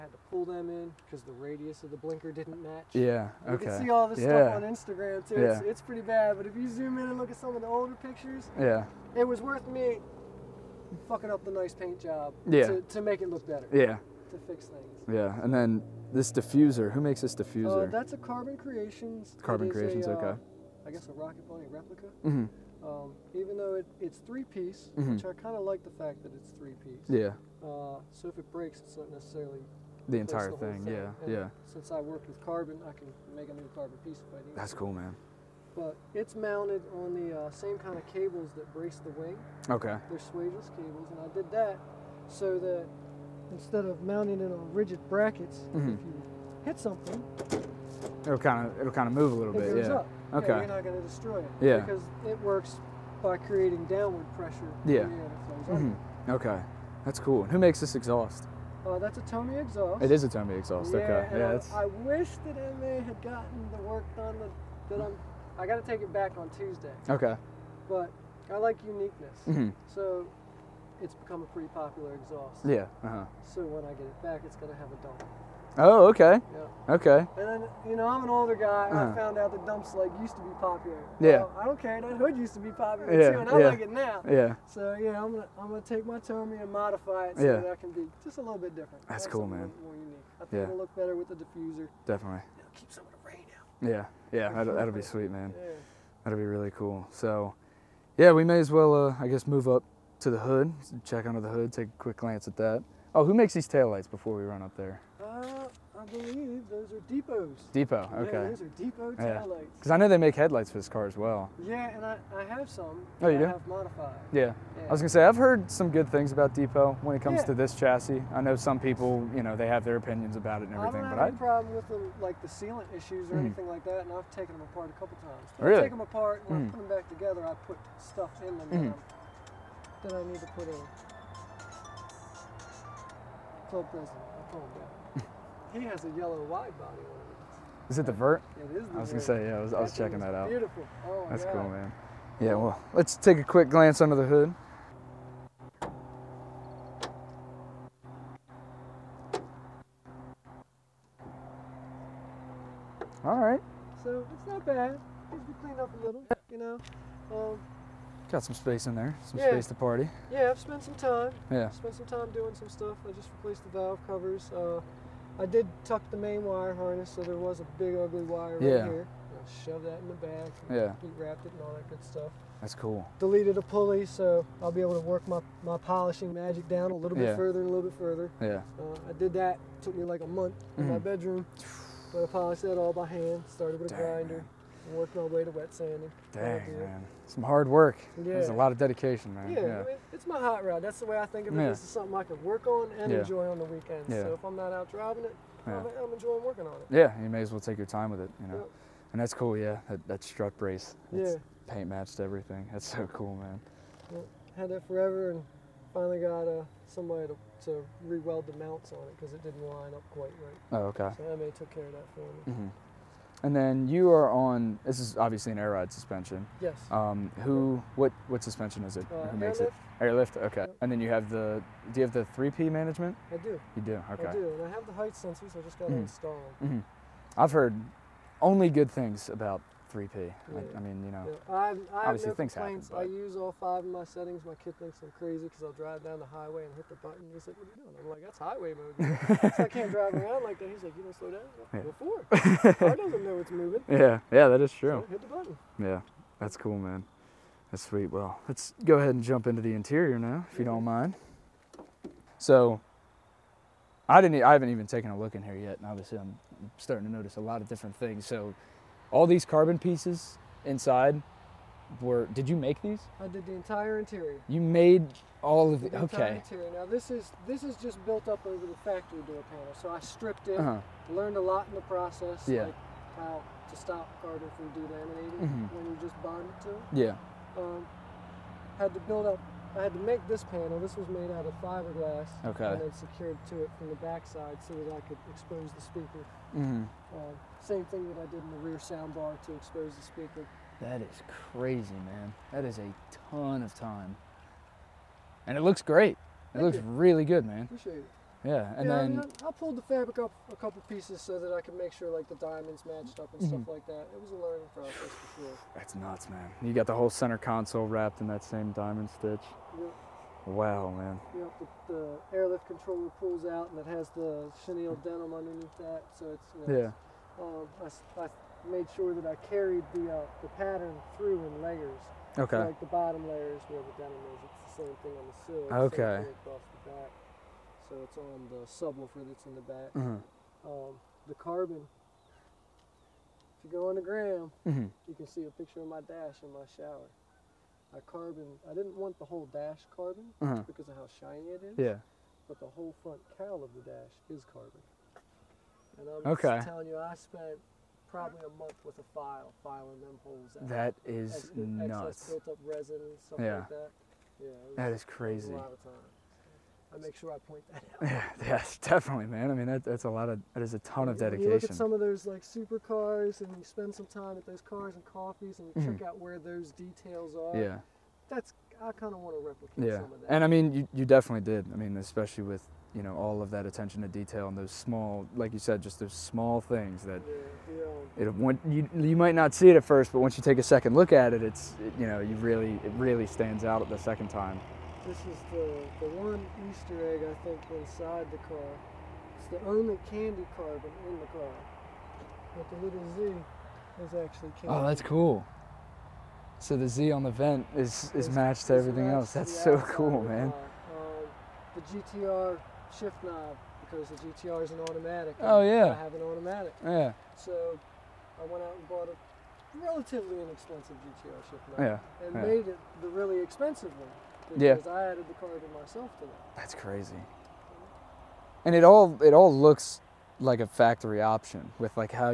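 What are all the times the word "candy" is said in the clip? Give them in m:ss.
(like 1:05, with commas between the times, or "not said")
6:30, 6:34.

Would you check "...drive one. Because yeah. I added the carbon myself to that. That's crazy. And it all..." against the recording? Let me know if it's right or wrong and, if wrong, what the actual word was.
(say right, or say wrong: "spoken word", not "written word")
wrong: "expensive", not "drive".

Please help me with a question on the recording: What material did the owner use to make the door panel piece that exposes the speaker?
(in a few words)
fiberglass.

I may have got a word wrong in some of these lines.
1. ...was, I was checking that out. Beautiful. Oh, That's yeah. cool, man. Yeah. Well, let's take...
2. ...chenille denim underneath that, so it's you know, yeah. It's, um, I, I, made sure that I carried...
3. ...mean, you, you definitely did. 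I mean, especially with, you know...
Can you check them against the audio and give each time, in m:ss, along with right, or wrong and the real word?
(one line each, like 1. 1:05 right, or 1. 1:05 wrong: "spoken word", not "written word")
1. 2:19 right
2. 5:14 right
3. 6:10 right.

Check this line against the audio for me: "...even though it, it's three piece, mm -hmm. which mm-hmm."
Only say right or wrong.
right.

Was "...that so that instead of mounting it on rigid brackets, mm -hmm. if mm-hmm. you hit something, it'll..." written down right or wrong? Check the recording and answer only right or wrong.
right.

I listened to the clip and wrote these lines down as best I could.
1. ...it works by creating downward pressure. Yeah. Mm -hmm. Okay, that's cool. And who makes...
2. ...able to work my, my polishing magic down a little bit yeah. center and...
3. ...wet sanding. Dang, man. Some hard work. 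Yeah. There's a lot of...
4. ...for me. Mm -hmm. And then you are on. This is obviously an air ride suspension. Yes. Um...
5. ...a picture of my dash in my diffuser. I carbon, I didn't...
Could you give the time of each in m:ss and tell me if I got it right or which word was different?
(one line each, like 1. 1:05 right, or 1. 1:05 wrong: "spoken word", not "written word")
1. 0:52 right
2. 2:54 wrong: "further", not "center"
3. 3:05 right
4. 3:32 right
5. 5:35 wrong: "shower", not "diffuser".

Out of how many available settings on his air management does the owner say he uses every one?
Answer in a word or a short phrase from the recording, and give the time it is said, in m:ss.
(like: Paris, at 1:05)
5, at 3:53.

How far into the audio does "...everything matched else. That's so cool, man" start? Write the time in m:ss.
6:38.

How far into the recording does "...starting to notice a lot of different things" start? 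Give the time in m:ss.
4:16.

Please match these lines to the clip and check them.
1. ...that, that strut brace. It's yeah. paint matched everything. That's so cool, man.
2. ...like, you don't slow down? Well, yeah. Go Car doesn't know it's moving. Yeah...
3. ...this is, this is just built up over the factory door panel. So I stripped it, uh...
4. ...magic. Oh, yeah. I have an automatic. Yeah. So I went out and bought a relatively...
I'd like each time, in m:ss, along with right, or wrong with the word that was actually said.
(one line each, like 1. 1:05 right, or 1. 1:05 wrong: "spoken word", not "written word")
1. 3:19 right
2. 4:00 right
3. 4:26 right
4. 6:44 wrong: "automatic", not "magic".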